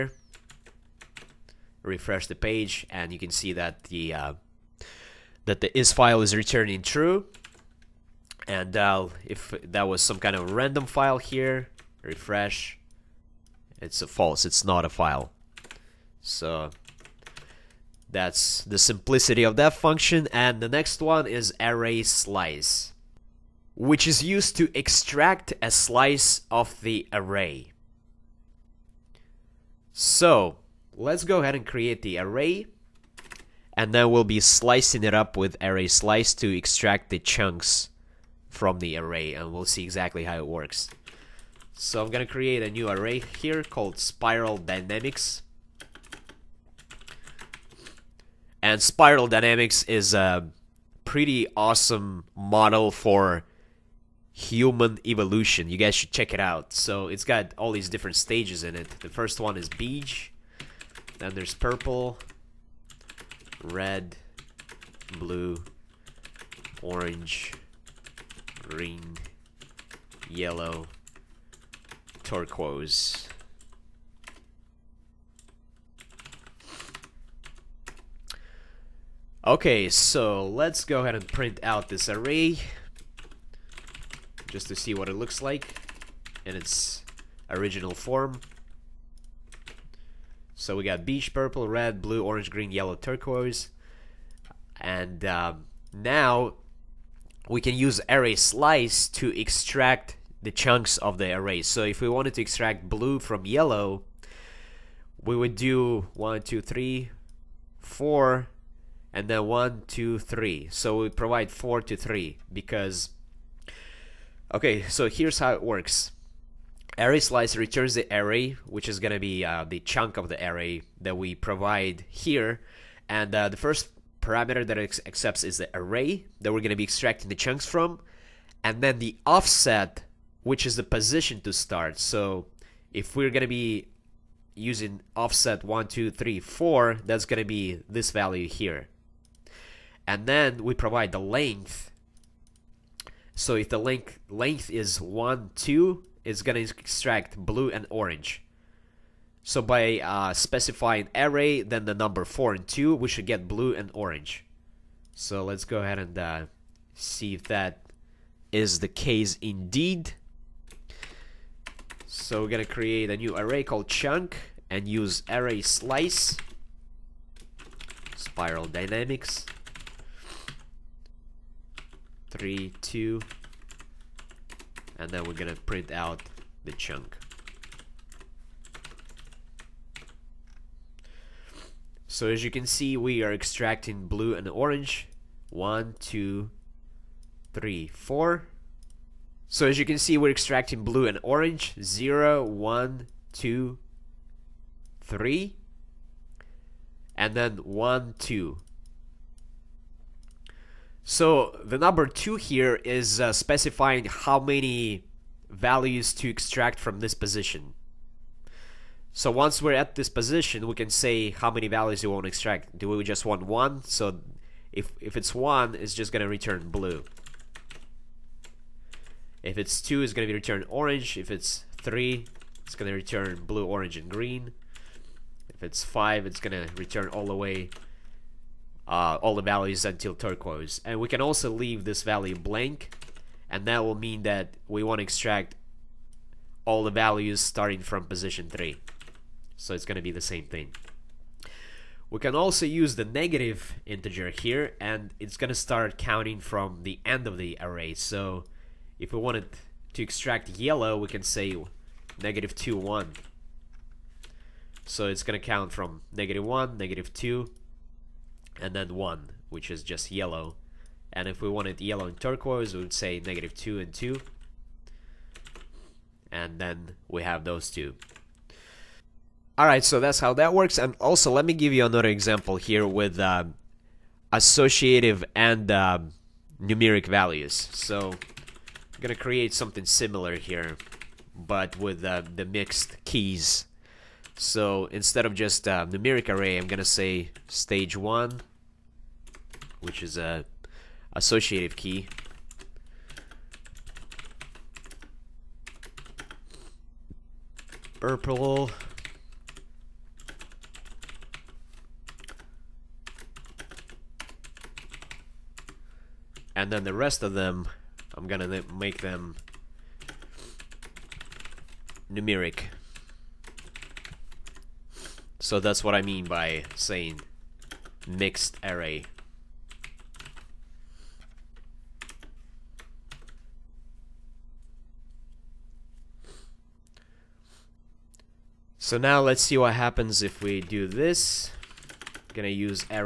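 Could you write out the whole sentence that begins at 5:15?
So that's what I mean by saying mixed array.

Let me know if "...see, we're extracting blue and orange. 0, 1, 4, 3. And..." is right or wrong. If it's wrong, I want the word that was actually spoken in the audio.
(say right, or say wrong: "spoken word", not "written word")
wrong: "2", not "4".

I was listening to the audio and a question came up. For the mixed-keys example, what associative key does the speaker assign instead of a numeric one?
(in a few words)
stage one.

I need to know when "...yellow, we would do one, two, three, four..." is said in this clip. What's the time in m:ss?
1:43.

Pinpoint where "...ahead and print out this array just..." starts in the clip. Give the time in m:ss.
1:21.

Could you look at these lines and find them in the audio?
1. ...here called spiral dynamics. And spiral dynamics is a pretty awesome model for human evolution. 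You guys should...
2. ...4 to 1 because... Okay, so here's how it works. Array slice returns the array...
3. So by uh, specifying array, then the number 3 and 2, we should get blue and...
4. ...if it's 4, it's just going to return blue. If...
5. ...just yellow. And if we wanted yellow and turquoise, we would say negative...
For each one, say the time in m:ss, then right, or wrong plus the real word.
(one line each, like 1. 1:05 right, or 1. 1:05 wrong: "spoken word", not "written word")
1. 0:43 right
2. 1:51 wrong: "3", not "1"
3. 2:29 wrong: "4", not "3"
4. 3:35 wrong: "1", not "4"
5. 4:19 right.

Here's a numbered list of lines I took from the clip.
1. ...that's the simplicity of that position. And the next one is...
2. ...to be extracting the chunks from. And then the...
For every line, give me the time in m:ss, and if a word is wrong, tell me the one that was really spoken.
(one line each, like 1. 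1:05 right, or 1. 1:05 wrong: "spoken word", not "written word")
1. 0:18 wrong: "function", not "position"
2. 2:06 right.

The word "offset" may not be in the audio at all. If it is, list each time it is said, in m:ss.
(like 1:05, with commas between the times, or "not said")
2:09, 2:15.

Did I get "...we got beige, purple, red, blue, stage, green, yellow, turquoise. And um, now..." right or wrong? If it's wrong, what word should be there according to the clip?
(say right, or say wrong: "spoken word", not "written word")
wrong: "orange", not "stage".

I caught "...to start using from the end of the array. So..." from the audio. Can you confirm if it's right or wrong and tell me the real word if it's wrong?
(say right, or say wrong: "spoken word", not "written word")
wrong: "counting", not "using".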